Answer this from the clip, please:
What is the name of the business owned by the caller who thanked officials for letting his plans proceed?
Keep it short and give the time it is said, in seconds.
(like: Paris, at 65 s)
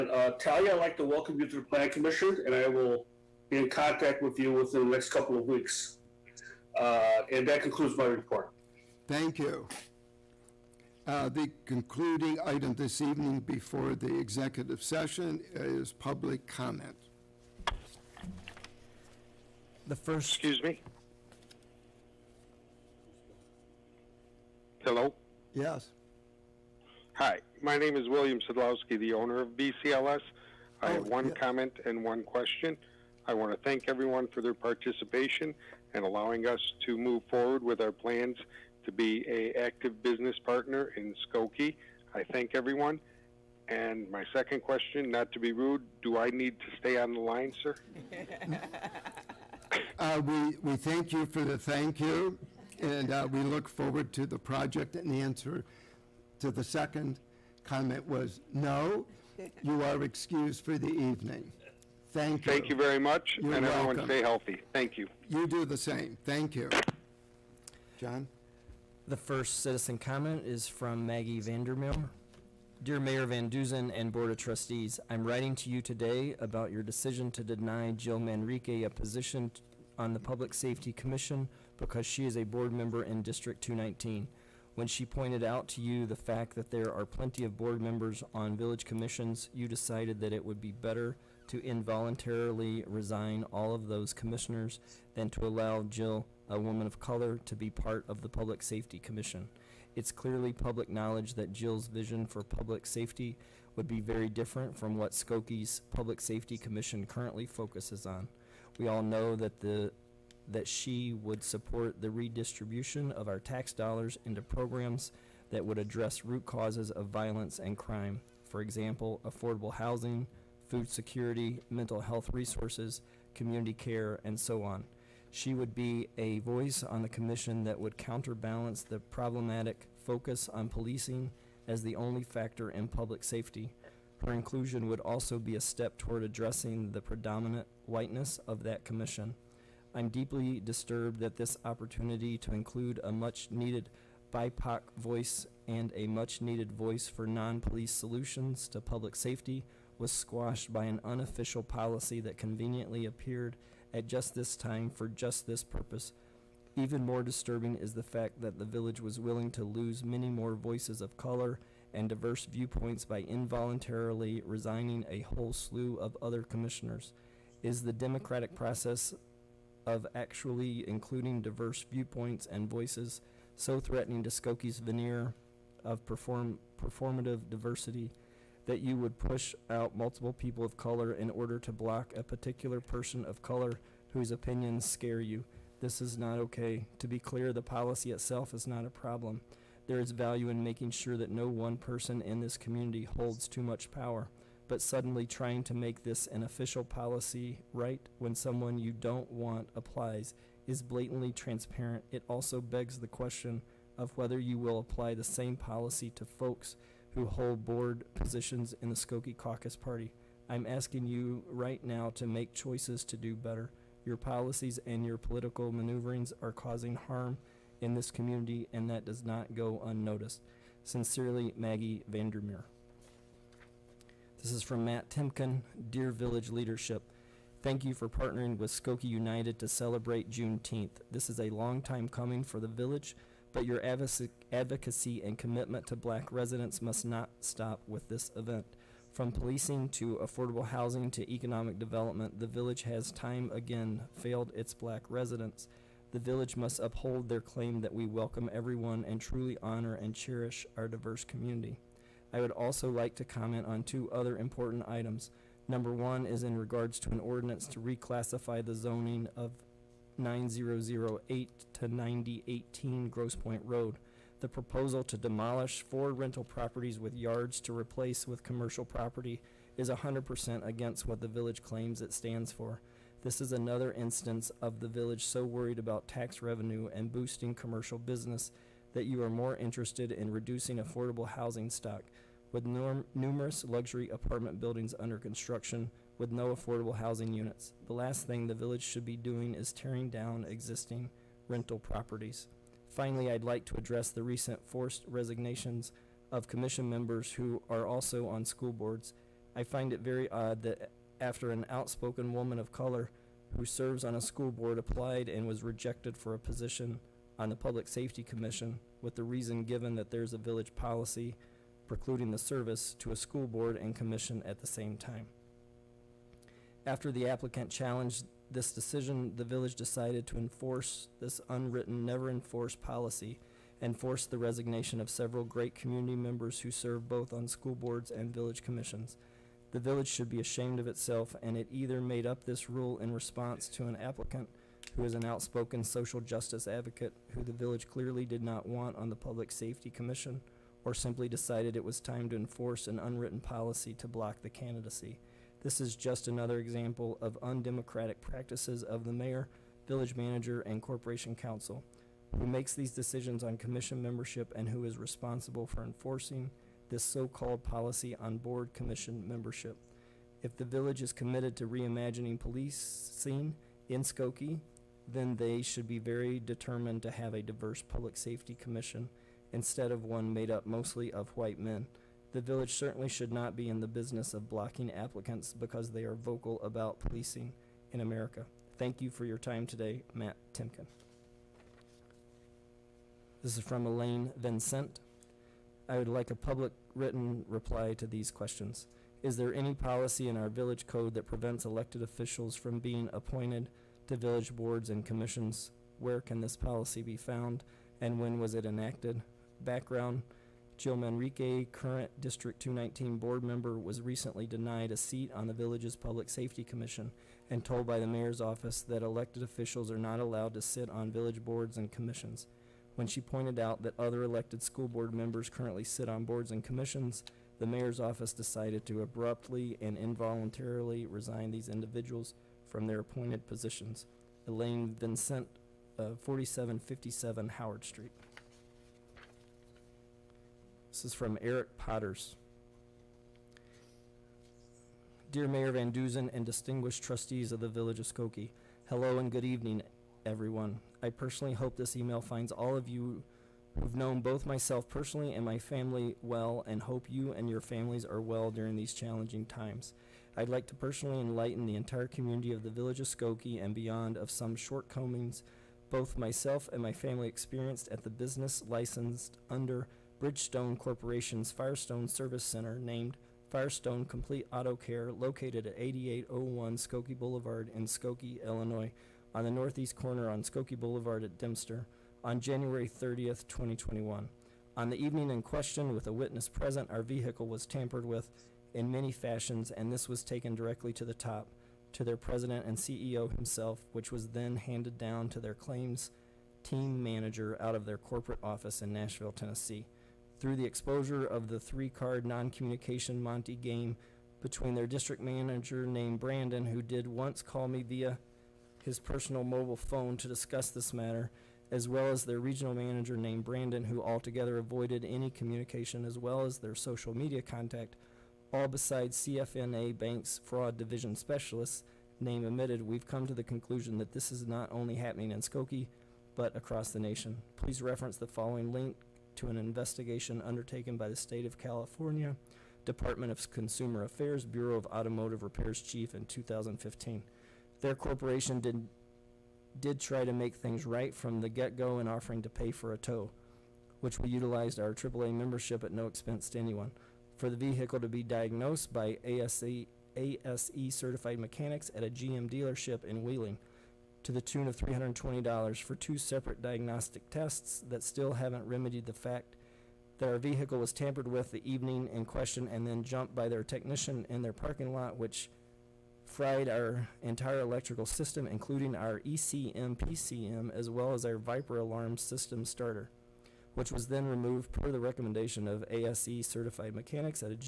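BCLS, at 29 s.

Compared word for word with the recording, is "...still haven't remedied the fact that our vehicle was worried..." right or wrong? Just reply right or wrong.
wrong.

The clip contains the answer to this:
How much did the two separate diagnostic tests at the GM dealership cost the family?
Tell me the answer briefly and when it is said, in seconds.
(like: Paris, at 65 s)
$320, at 544 s.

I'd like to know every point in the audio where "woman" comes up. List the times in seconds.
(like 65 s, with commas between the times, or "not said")
96 s, 302 s.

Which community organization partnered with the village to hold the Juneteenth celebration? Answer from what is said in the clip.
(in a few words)
Skokie United.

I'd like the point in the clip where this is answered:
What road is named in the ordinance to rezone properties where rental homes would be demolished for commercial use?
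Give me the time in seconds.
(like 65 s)
263 s.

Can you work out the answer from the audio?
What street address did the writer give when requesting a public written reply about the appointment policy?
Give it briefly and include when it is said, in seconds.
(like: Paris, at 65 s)
4757 Howard Street, at 426 s.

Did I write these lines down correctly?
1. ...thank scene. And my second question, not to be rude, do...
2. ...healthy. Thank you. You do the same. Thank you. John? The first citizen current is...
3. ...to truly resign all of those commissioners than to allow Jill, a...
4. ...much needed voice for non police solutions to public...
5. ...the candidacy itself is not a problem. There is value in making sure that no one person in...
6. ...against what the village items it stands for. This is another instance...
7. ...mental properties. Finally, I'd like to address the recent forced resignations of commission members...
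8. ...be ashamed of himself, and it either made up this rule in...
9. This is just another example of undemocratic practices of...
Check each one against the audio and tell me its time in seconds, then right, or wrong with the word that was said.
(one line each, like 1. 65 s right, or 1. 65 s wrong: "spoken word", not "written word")
1. 42 s wrong: "everyone", not "scene"
2. 64 s wrong: "comment", not "current"
3. 91 s wrong: "involuntarily", not "truly"
4. 146 s right
5. 187 s wrong: "policy", not "candidacy"
6. 270 s wrong: "claims", not "items"
7. 291 s wrong: "rental", not "mental"
8. 330 s wrong: "itself", not "himself"
9. 345 s right.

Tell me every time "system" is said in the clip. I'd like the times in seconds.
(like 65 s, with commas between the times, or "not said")
558 s, 562 s.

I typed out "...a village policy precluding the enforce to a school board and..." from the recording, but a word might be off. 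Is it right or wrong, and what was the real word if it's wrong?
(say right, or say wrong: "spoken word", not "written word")
wrong: "service", not "enforce".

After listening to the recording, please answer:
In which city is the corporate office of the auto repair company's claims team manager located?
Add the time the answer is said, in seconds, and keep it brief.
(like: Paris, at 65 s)
Nashville, at 488 s.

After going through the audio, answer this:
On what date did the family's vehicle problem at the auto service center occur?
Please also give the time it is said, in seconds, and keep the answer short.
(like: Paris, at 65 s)
January 30th, 2021, at 472 s.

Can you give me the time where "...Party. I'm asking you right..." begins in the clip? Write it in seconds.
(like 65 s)
209 s.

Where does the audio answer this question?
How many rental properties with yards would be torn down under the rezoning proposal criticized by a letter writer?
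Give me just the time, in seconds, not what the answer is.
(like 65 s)
265 s.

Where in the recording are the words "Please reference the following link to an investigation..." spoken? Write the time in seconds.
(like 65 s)
517 s.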